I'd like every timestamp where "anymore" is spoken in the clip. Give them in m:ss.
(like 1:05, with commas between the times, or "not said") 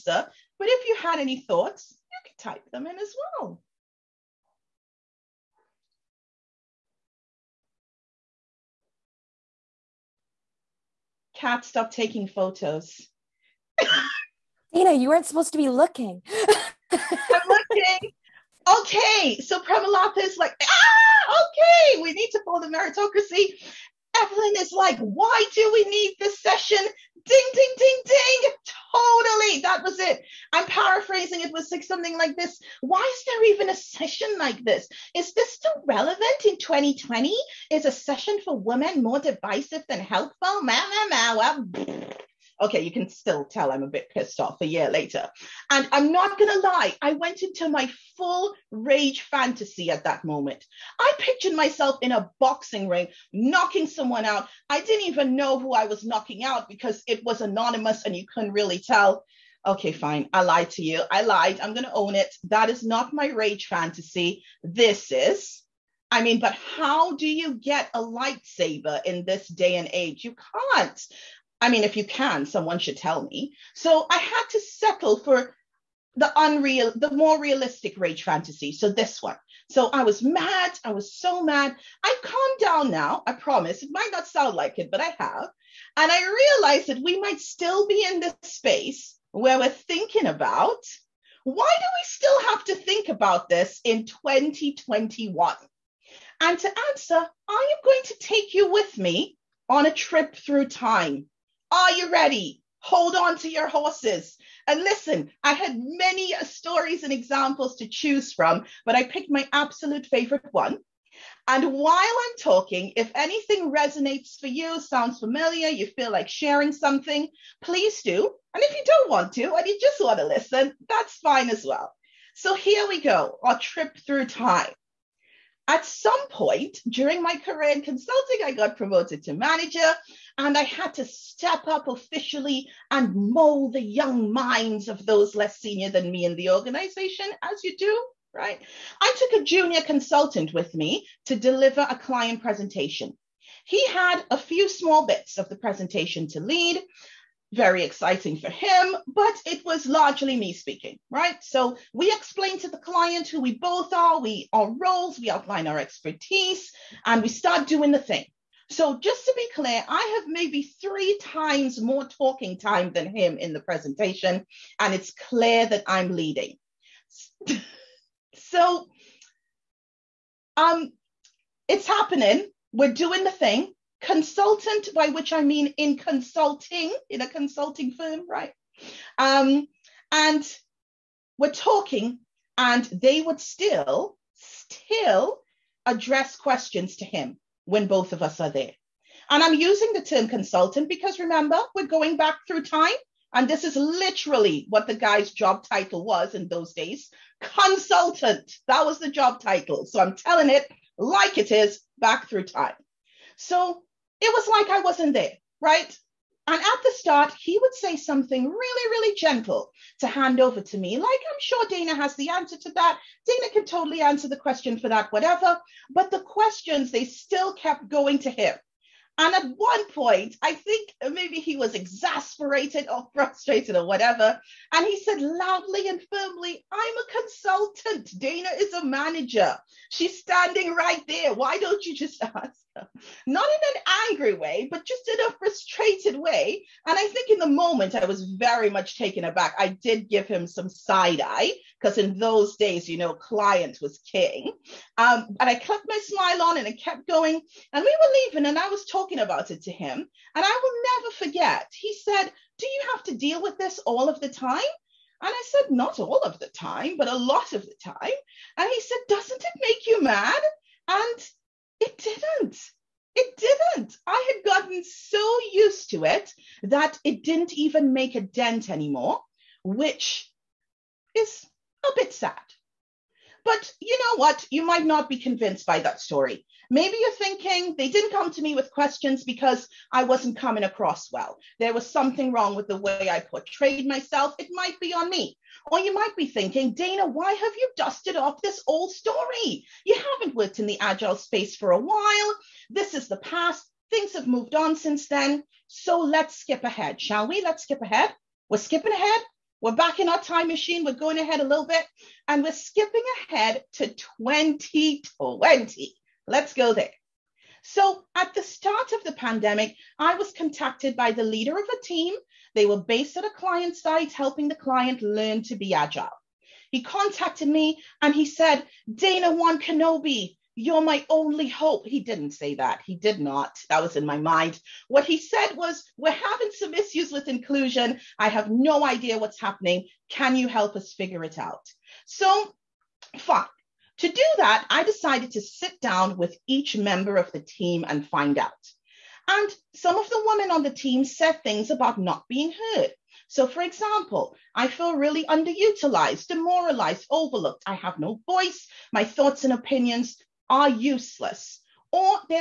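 4:28.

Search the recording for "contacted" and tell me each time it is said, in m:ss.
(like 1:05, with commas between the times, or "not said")
5:10, 5:16.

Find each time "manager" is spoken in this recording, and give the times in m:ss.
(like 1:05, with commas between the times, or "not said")
2:09, 3:48.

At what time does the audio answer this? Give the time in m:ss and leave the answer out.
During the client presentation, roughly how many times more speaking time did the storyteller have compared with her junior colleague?
2:40.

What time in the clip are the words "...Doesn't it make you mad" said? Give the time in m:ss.
4:19.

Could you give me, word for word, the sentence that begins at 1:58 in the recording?
And if you don't want to and you just want to listen, that's fine as well.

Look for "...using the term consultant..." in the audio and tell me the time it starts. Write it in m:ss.
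3:09.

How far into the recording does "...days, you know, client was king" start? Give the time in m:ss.
4:02.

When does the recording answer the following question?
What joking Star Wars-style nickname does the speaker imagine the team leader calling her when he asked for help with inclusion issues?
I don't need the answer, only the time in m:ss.
5:18.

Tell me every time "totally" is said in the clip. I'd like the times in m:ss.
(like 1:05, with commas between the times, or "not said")
0:28, 3:33.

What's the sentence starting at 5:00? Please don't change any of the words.
We're going ahead a little bit and we're skipping ahead to 2020.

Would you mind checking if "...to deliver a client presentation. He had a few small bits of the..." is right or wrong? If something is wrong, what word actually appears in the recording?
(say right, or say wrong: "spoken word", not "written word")
right.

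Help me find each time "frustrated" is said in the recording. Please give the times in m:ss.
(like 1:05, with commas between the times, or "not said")
3:43, 3:55.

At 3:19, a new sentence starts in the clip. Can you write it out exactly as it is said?
So I'm telling it like it is back through time.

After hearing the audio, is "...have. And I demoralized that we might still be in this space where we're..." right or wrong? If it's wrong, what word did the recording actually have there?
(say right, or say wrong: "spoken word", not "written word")
wrong: "realized", not "demoralized".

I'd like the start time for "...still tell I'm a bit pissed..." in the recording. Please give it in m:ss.
0:43.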